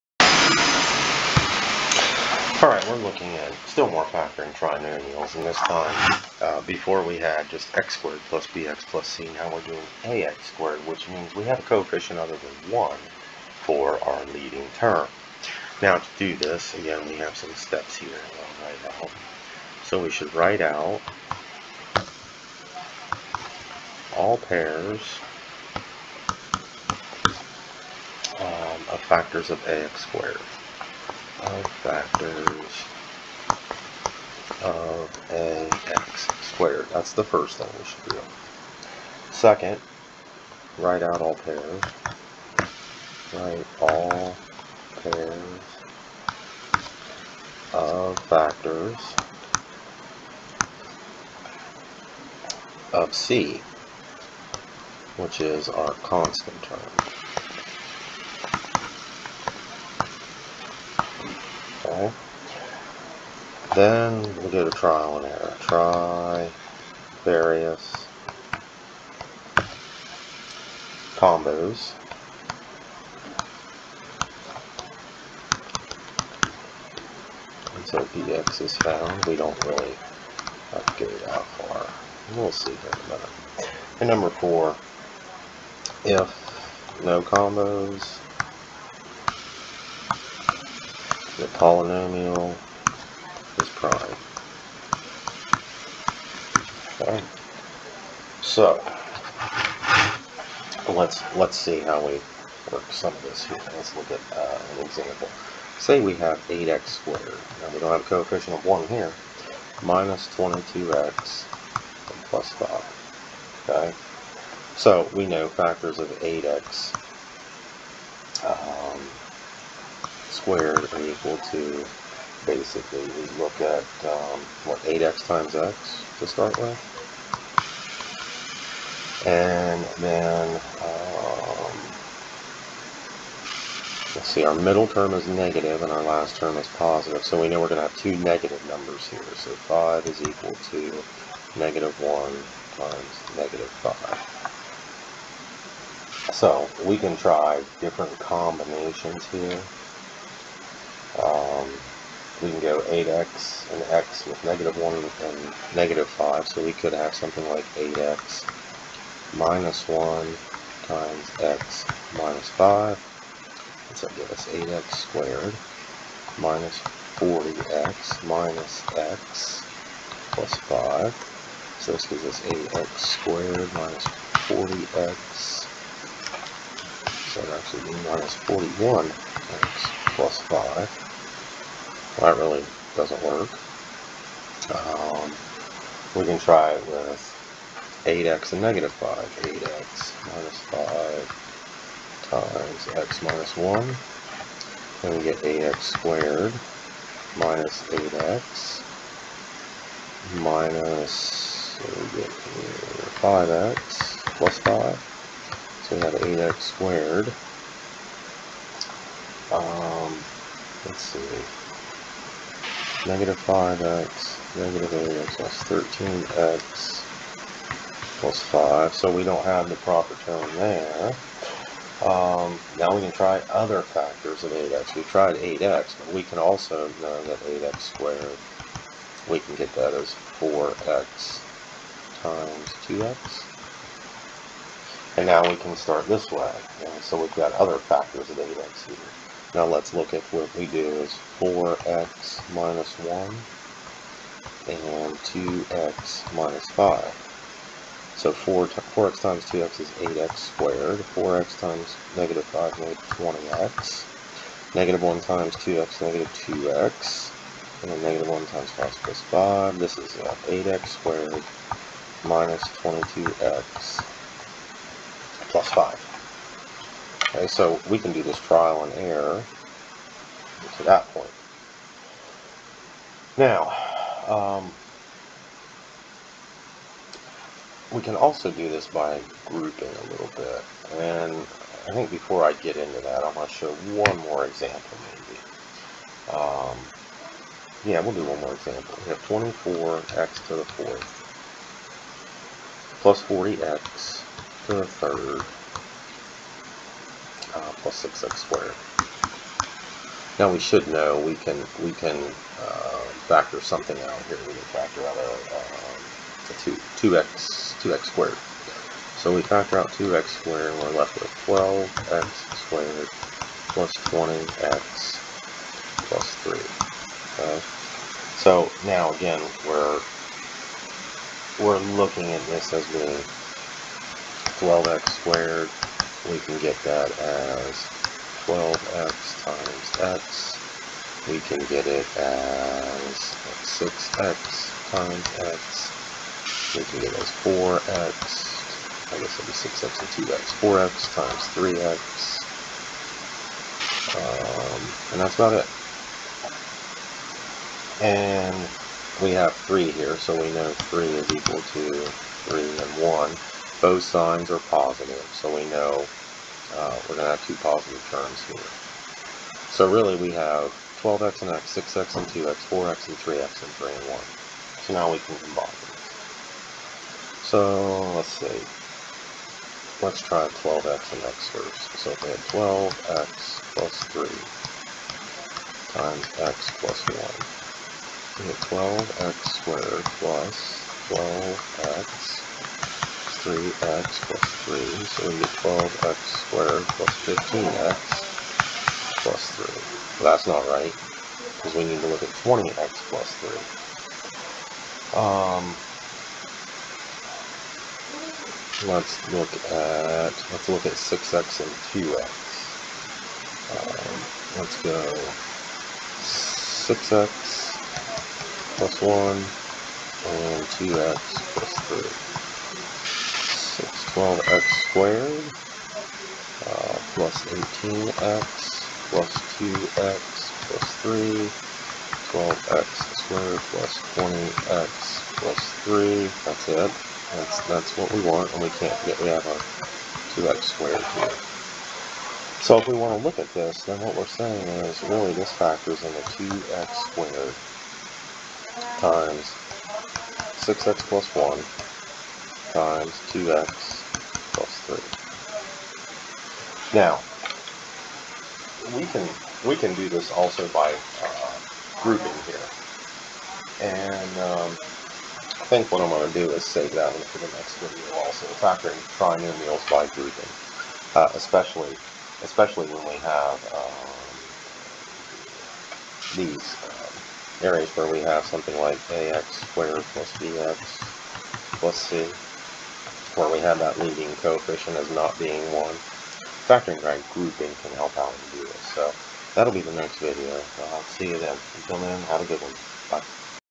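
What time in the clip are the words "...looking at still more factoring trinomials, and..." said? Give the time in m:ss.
0:02.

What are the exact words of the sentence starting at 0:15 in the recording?
Now to do this, again, we have some steps here I'll write out.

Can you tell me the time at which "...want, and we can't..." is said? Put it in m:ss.
7:08.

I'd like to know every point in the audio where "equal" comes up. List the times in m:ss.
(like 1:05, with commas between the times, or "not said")
2:01, 2:20, 5:51.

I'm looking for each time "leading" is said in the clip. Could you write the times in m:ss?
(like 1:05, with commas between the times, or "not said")
0:14, 7:53.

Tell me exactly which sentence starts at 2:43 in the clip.
So that gives us 8x squared minus 40x minus x plus 5.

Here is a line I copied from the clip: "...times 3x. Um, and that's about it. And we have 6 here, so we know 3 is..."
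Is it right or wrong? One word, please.
wrong.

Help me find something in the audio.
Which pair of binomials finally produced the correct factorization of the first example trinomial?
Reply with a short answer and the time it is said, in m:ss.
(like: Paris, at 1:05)
4x - 1 and 2x - 5, at 4:01.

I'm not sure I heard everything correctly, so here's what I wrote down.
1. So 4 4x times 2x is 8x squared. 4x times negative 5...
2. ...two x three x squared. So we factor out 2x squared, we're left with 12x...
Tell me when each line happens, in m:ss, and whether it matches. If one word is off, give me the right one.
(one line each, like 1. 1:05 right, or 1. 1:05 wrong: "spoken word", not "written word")
1. 4:08 right
2. 5:06 wrong: "two", not "three".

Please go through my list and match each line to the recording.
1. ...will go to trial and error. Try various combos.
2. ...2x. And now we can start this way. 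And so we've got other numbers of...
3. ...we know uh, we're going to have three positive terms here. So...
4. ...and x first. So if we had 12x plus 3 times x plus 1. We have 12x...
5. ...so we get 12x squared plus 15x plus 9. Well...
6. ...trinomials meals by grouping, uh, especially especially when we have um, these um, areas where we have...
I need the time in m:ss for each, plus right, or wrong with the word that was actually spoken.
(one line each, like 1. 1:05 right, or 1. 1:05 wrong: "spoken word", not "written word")
1. 1:04 right
2. 3:52 wrong: "factors", not "numbers"
3. 5:55 wrong: "two", not "three"
4. 6:11 right
5. 6:25 wrong: "3", not "9"
6. 7:39 right.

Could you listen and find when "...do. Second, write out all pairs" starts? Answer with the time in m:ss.
0:38.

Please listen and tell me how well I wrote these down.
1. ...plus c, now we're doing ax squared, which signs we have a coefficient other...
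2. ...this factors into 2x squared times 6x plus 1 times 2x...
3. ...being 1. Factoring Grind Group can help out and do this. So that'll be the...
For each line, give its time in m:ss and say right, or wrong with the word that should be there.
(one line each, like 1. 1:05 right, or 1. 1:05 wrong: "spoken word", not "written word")
1. 0:08 wrong: "means", not "signs"
2. 7:15 right
3. 7:55 right.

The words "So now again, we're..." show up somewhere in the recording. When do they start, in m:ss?
5:18.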